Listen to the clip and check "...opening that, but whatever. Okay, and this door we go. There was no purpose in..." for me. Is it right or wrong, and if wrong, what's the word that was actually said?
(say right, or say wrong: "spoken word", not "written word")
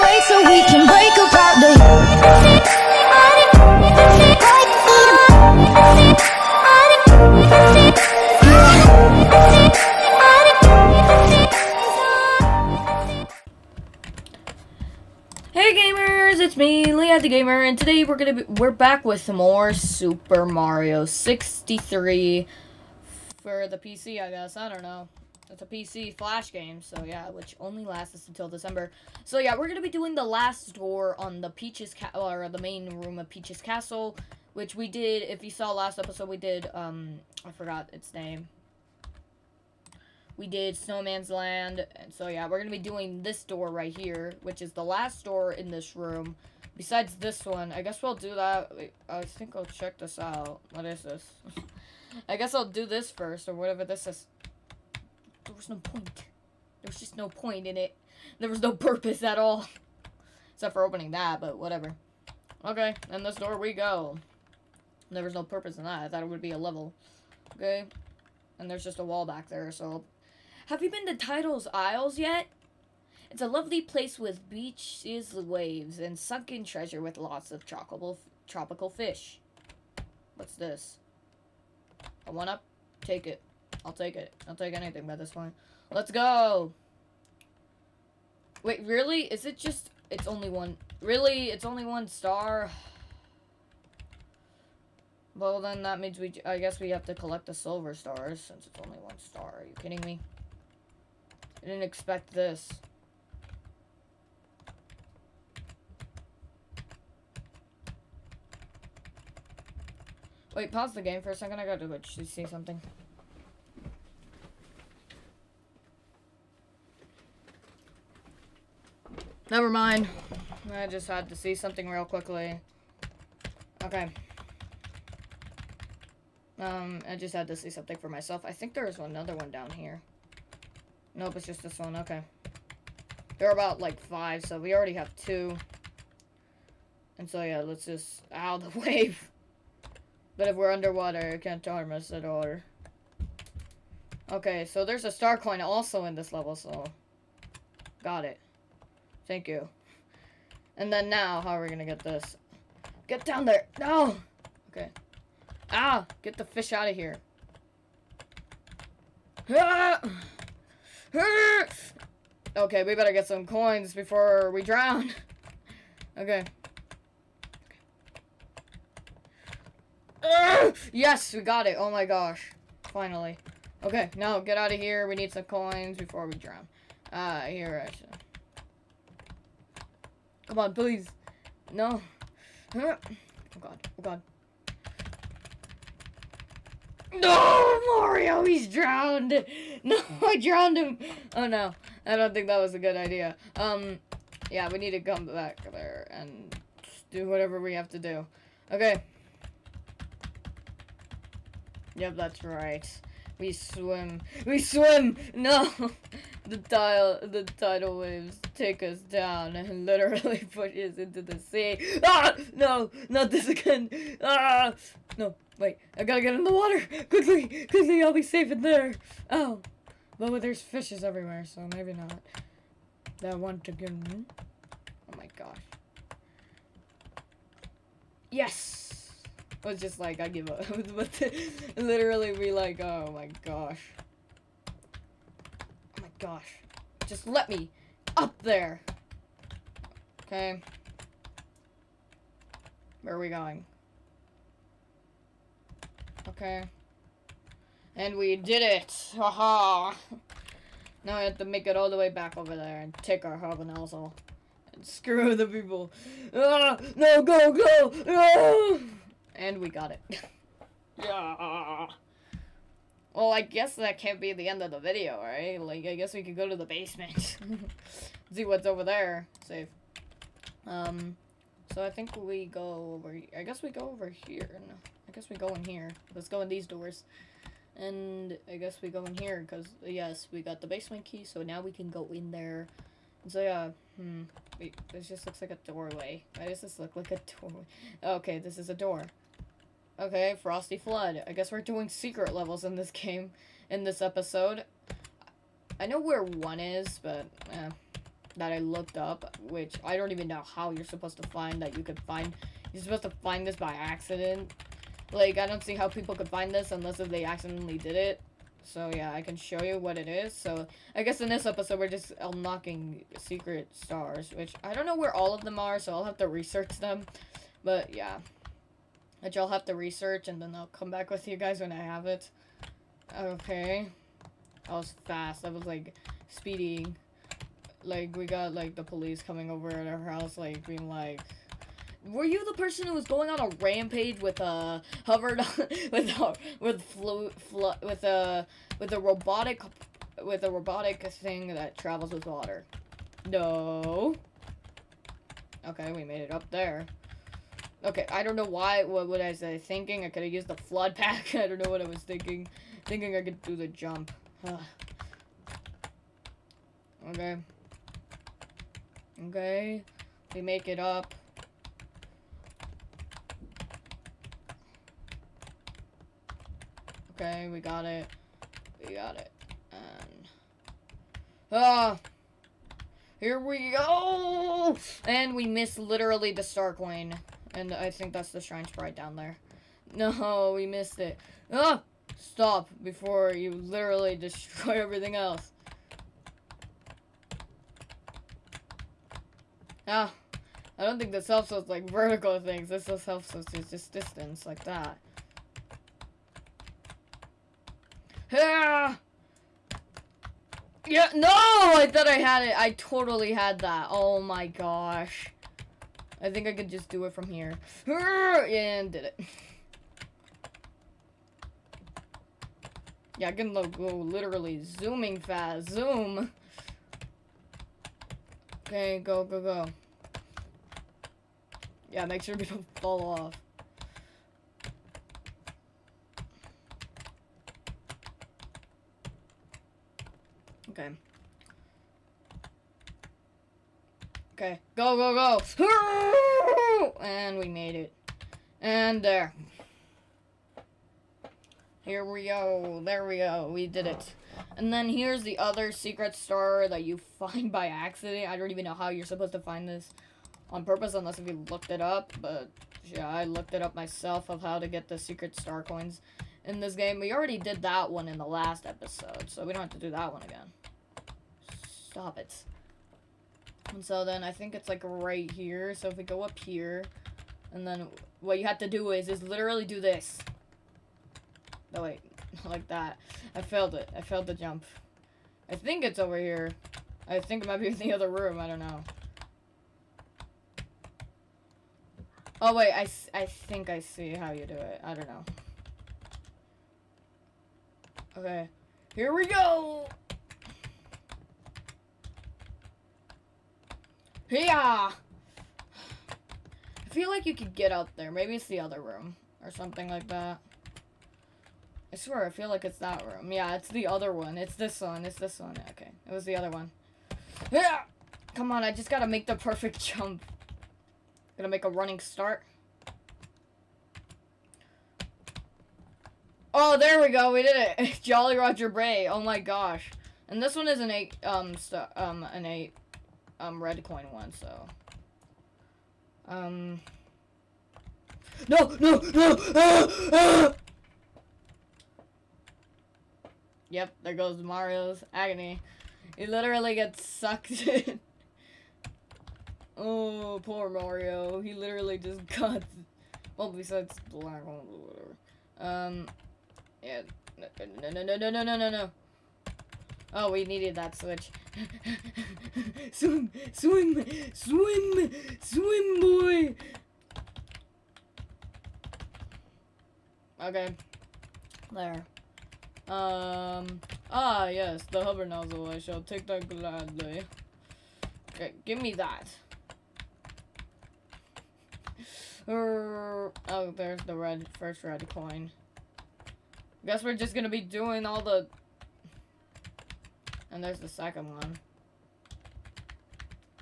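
right.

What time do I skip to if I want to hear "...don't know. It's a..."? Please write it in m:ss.
0:24.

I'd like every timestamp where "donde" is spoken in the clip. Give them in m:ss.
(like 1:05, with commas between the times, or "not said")
not said.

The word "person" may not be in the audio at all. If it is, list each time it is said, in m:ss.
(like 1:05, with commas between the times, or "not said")
5:32.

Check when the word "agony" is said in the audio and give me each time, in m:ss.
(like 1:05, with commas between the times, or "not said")
8:55.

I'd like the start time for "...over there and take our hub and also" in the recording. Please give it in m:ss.
4:12.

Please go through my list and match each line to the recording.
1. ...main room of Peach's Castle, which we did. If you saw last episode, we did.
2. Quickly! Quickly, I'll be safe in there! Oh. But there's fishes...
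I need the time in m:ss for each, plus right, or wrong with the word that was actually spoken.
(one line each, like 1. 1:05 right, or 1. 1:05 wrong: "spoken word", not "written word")
1. 0:32 right
2. 3:37 right.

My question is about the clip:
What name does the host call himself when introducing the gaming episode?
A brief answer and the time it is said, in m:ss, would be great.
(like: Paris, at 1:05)
Lehi the Gamer, at 0:16.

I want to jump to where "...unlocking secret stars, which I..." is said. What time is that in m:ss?
5:12.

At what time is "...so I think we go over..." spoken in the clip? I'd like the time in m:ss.
4:31.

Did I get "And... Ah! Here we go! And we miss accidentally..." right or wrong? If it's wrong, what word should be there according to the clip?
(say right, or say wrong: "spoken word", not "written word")
wrong: "literally", not "accidentally".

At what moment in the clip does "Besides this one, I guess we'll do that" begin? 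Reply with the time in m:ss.
0:46.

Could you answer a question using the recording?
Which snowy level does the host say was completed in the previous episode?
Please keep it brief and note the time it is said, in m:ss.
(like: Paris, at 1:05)
Snowman's Land, at 0:40.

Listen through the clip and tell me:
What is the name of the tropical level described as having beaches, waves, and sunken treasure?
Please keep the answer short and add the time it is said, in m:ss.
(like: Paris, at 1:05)
Tidal's Isles, at 1:11.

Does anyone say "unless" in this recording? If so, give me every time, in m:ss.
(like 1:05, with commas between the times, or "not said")
5:06, 7:30.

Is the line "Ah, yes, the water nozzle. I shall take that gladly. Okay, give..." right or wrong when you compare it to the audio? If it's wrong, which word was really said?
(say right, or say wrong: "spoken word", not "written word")
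wrong: "hover", not "water".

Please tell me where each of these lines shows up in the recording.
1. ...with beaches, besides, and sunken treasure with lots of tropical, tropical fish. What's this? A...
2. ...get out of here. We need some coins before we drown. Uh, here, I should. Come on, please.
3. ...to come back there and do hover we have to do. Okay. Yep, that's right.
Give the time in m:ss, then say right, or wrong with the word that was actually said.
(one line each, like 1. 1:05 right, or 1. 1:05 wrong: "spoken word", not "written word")
1. 1:14 wrong: "waves", not "besides"
2. 2:54 right
3. 3:14 wrong: "whatever", not "hover".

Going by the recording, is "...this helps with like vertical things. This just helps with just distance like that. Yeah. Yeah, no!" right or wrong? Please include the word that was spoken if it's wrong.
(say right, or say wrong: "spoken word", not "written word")
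right.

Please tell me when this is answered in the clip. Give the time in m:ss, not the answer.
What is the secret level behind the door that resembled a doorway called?
4:50.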